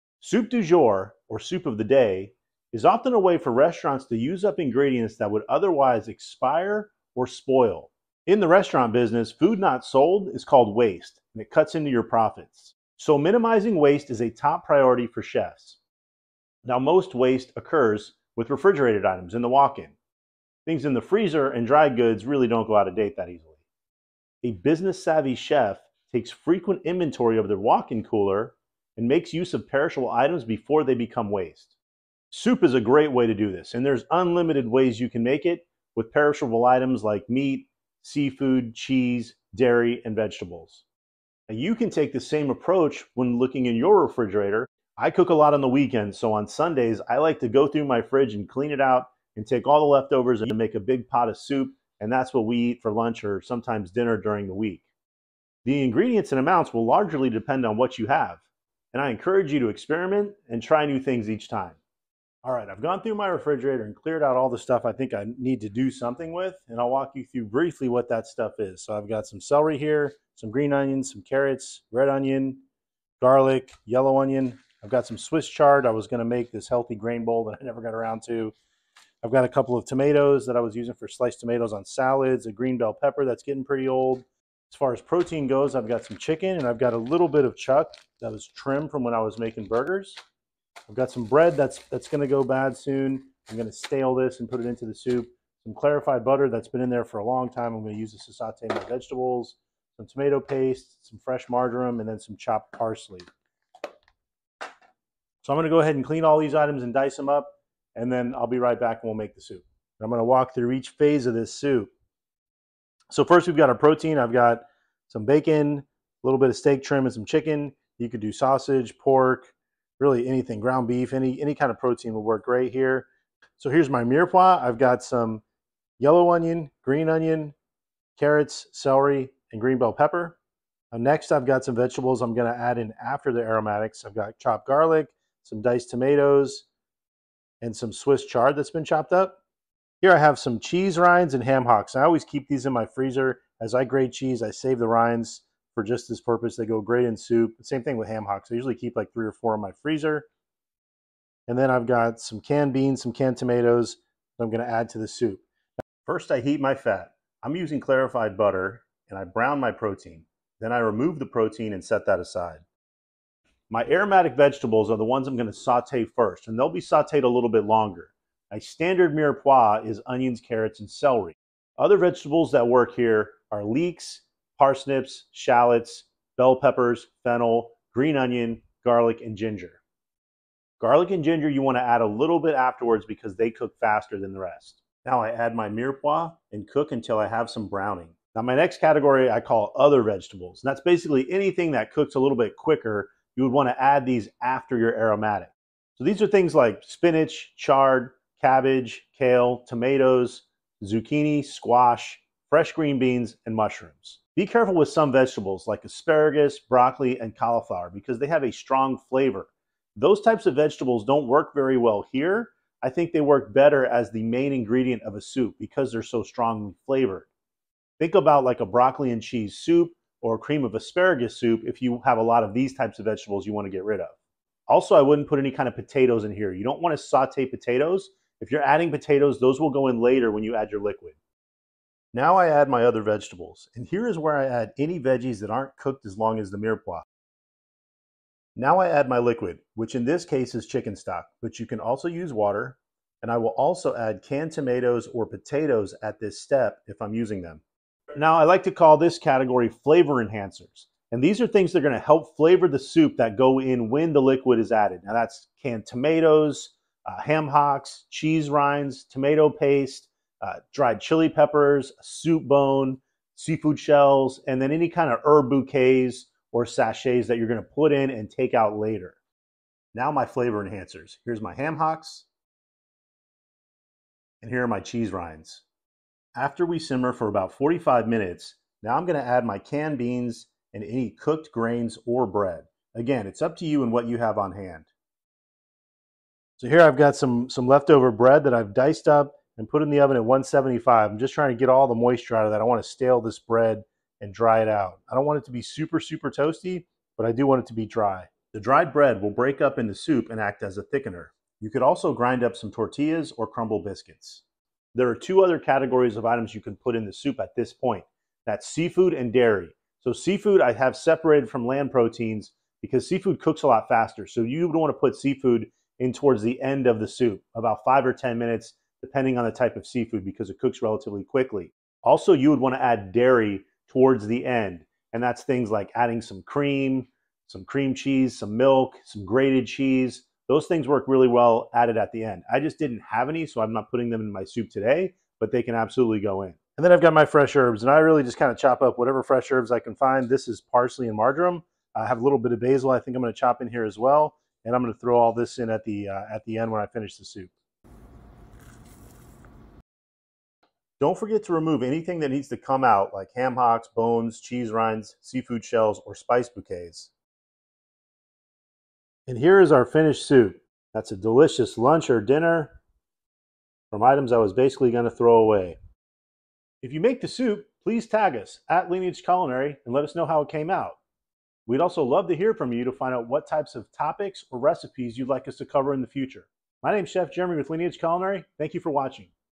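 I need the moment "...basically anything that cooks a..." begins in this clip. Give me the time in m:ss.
3:10.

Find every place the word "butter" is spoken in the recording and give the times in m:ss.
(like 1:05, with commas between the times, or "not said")
1:36, 2:38.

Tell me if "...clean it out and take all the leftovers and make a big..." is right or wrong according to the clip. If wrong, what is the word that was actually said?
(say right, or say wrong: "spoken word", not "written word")
right.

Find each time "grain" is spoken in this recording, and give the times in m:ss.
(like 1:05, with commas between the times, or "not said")
1:16, 4:41.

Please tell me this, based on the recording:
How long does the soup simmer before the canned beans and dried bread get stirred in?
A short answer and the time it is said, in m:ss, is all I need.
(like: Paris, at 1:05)
45 minutes, at 4:37.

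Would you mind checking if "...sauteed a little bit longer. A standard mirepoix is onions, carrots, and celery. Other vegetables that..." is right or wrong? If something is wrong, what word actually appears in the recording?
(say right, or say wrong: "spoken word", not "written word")
right.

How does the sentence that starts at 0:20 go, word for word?
Things in the freezer and dry goods really don't go out of date that easily.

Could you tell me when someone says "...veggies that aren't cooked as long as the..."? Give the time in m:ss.
3:54.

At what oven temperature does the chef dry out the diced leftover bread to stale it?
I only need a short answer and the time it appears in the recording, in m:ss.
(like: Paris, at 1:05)
175, at 4:50.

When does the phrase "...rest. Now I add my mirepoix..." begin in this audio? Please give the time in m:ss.
3:04.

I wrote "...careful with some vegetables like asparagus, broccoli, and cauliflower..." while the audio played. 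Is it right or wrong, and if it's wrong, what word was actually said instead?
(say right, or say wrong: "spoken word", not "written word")
right.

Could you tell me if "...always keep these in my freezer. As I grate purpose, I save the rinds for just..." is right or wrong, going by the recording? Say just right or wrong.
wrong.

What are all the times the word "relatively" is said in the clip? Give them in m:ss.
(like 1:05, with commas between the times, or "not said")
5:20.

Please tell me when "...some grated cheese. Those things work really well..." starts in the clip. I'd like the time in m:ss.
5:29.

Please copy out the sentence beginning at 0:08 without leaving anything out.
In the restaurant business, food not sold is called waste, and it cuts into your profits.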